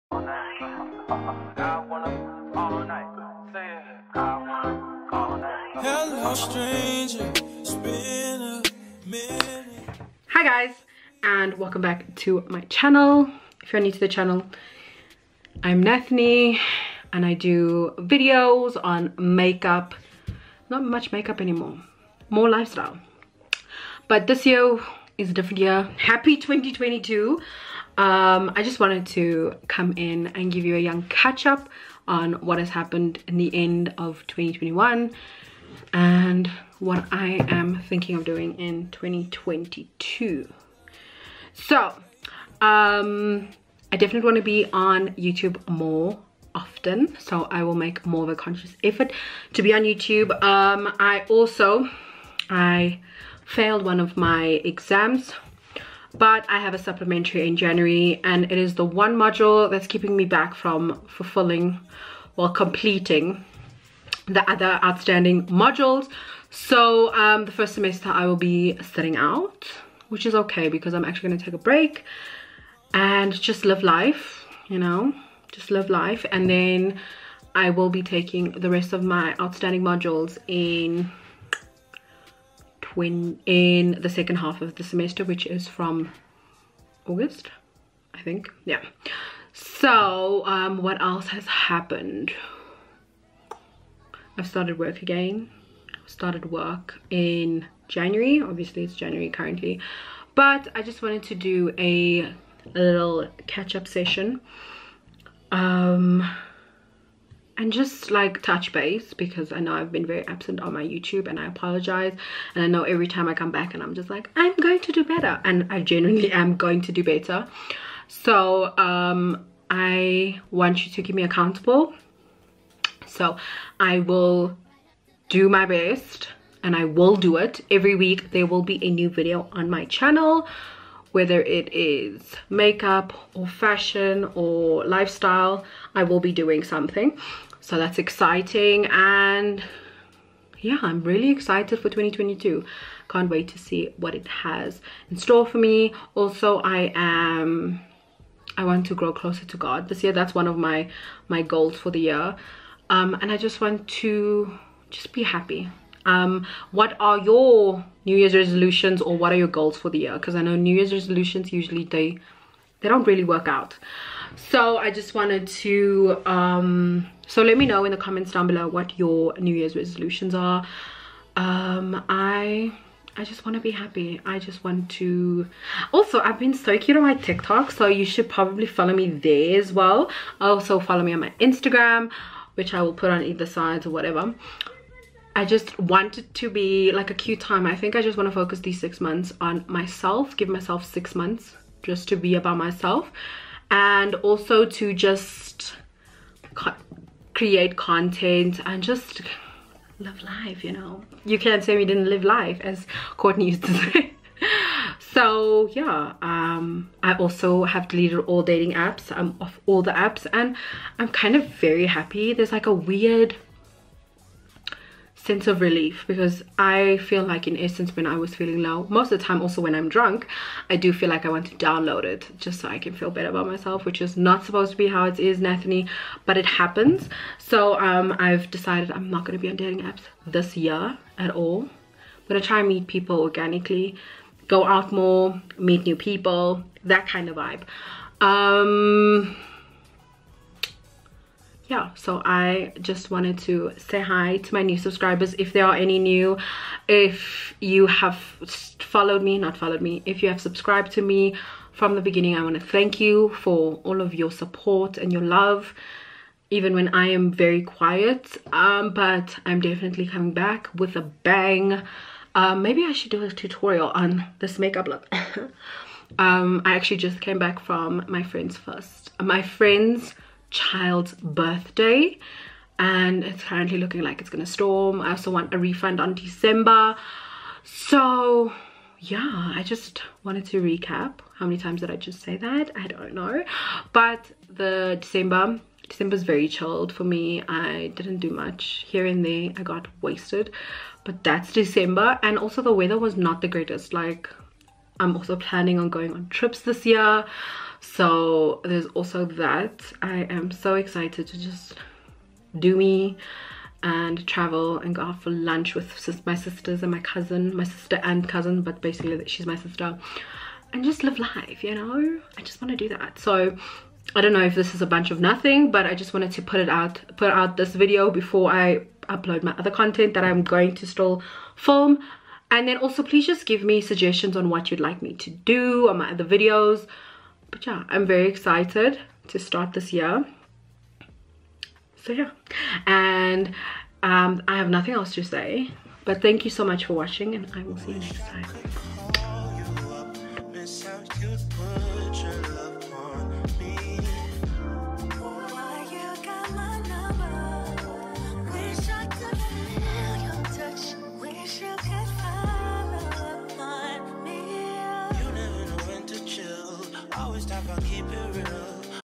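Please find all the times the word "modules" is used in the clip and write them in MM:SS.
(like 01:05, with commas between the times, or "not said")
00:59, 01:05, 01:19.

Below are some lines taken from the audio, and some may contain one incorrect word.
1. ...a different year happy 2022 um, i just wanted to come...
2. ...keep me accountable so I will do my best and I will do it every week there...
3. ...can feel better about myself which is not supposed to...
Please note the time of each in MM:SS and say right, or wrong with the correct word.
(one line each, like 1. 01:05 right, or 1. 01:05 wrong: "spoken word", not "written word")
1. 00:25 right
2. 02:01 right
3. 03:42 right.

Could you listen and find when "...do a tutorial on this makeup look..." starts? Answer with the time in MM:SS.
04:23.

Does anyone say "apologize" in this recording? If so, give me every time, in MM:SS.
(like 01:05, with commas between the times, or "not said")
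01:51.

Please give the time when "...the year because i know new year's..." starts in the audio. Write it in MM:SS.
02:39.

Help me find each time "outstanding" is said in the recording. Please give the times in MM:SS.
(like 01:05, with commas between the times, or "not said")
01:04, 01:19.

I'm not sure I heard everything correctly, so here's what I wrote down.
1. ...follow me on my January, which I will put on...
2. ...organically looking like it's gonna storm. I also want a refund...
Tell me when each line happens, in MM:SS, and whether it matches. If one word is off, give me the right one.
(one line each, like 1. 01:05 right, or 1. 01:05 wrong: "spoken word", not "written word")
1. 03:00 wrong: "Instagram", not "January"
2. 04:33 wrong: "currently", not "organically".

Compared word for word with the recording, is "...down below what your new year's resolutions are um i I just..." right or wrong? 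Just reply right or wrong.
right.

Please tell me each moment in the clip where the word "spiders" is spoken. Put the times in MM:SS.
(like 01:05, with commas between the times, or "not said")
not said.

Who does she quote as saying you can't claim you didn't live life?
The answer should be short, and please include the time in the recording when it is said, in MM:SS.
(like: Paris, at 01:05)
Courtney, at 03:23.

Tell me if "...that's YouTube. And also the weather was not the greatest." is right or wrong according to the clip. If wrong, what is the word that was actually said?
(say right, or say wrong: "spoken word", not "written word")
wrong: "December", not "YouTube".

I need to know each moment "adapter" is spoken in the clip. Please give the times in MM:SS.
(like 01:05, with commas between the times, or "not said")
not said.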